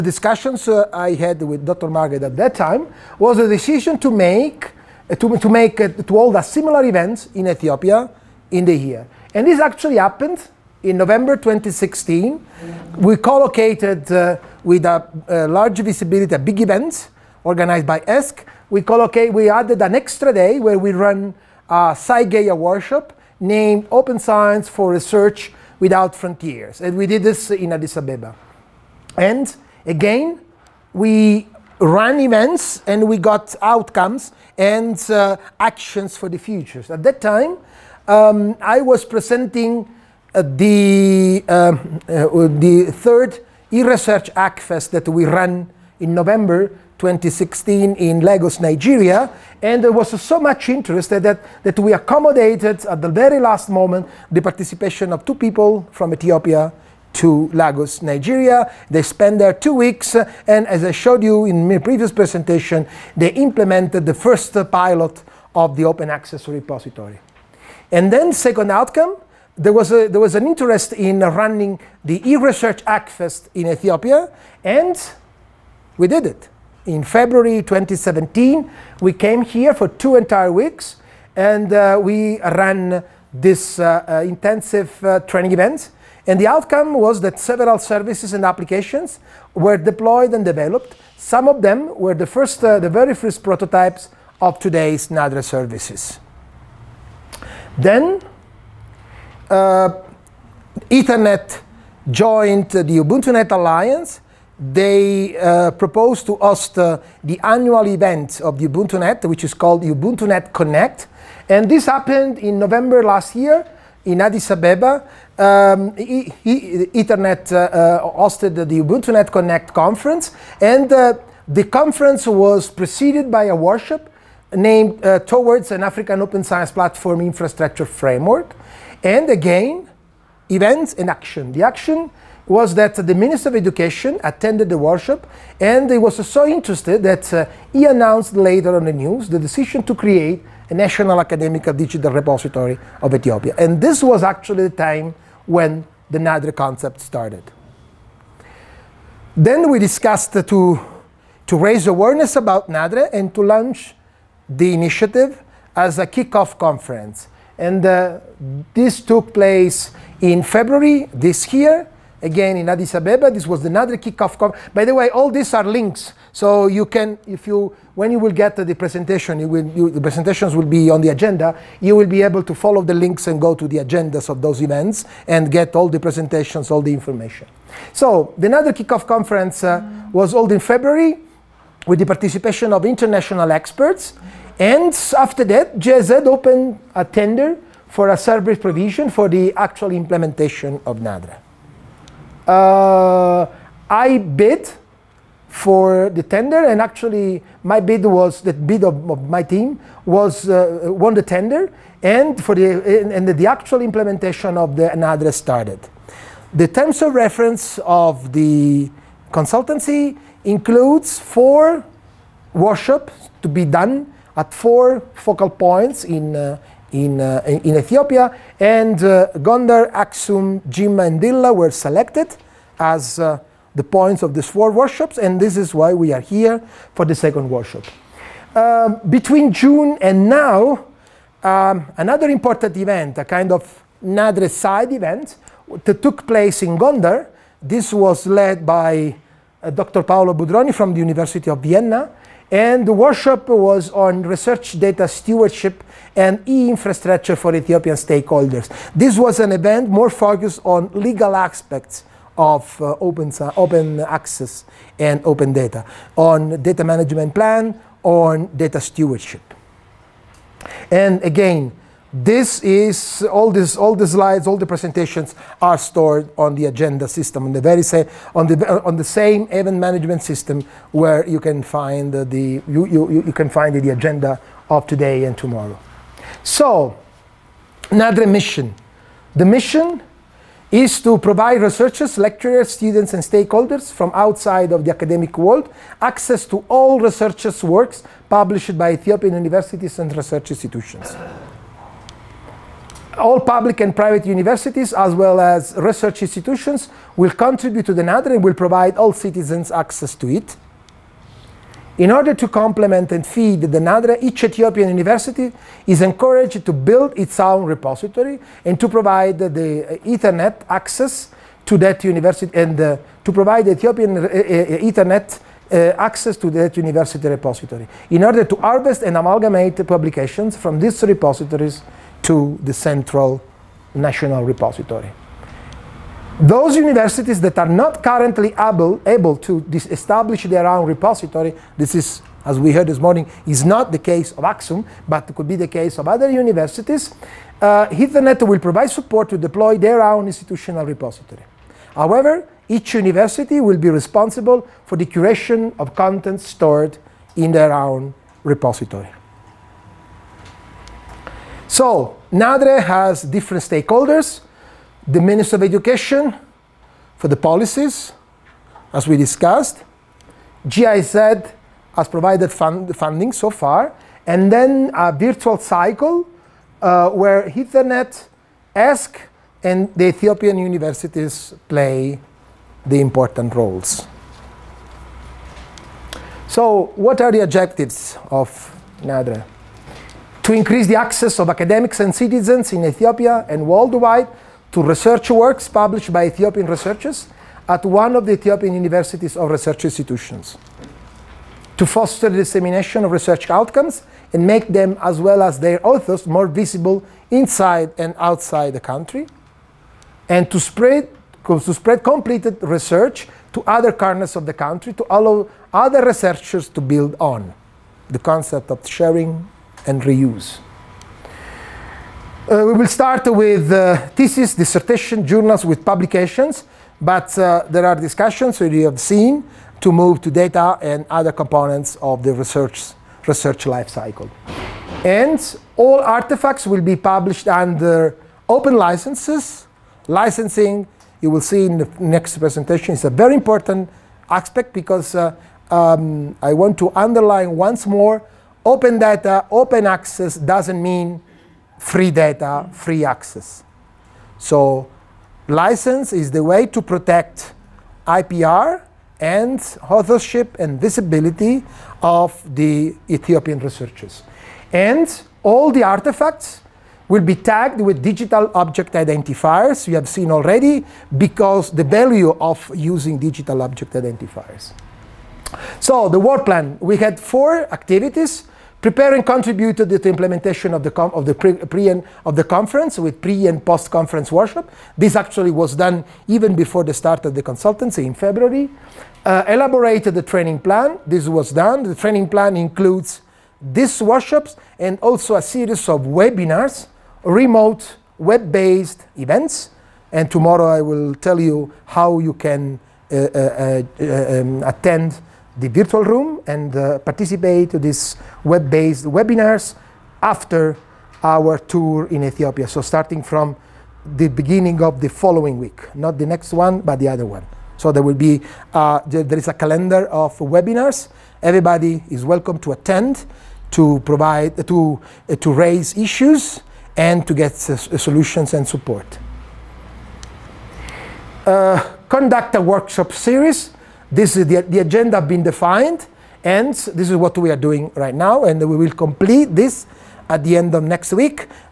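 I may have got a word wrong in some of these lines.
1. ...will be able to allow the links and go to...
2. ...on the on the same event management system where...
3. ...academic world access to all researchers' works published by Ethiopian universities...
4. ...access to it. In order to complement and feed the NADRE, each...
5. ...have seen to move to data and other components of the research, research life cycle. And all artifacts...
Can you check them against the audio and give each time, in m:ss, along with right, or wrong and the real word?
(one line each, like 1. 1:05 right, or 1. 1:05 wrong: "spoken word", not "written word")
1. 2:51 wrong: "follow", not "allow"
2. 4:28 right
3. 4:44 right
4. 4:59 right
5. 6:58 right.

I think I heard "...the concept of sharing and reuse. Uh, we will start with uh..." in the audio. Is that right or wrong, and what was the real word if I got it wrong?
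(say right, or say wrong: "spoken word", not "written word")
right.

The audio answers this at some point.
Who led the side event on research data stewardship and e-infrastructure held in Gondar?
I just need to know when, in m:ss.
3:59.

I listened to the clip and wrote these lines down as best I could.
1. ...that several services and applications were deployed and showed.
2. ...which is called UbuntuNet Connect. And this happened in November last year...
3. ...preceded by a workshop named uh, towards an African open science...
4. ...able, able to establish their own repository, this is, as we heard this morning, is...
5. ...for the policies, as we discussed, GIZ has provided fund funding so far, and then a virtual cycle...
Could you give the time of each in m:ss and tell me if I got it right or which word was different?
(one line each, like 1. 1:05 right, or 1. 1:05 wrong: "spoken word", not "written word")
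1. 1:27 wrong: "developed", not "showed"
2. 1:49 right
3. 2:02 right
4. 5:28 right
5. 5:57 right.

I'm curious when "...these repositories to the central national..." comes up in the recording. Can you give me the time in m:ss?
5:20.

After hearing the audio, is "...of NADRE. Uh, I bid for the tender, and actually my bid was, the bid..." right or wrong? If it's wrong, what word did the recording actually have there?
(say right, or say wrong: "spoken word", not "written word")
right.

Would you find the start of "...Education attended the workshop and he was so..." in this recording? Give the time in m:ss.
2:13.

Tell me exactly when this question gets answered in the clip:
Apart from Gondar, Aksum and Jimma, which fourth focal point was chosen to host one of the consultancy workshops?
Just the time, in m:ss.
3:41.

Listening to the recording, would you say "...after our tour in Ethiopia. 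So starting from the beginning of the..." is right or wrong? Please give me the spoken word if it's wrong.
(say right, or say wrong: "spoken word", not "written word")
right.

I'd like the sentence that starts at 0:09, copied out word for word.
And this actually happened in November 2016.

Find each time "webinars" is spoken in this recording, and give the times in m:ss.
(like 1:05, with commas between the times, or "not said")
8:06, 8:19, 8:30.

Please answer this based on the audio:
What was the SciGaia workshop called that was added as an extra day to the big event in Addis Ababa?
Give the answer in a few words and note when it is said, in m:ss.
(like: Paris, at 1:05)
Open Science for Research Without Frontiers, at 0:23.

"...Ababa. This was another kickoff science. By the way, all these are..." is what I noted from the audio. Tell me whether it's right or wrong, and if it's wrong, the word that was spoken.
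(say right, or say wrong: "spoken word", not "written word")
wrong: "conference", not "science".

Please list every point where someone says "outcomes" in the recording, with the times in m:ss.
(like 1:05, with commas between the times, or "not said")
0:33, 1:08, 1:26, 6:33.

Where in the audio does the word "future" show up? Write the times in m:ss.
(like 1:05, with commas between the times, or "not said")
0:36.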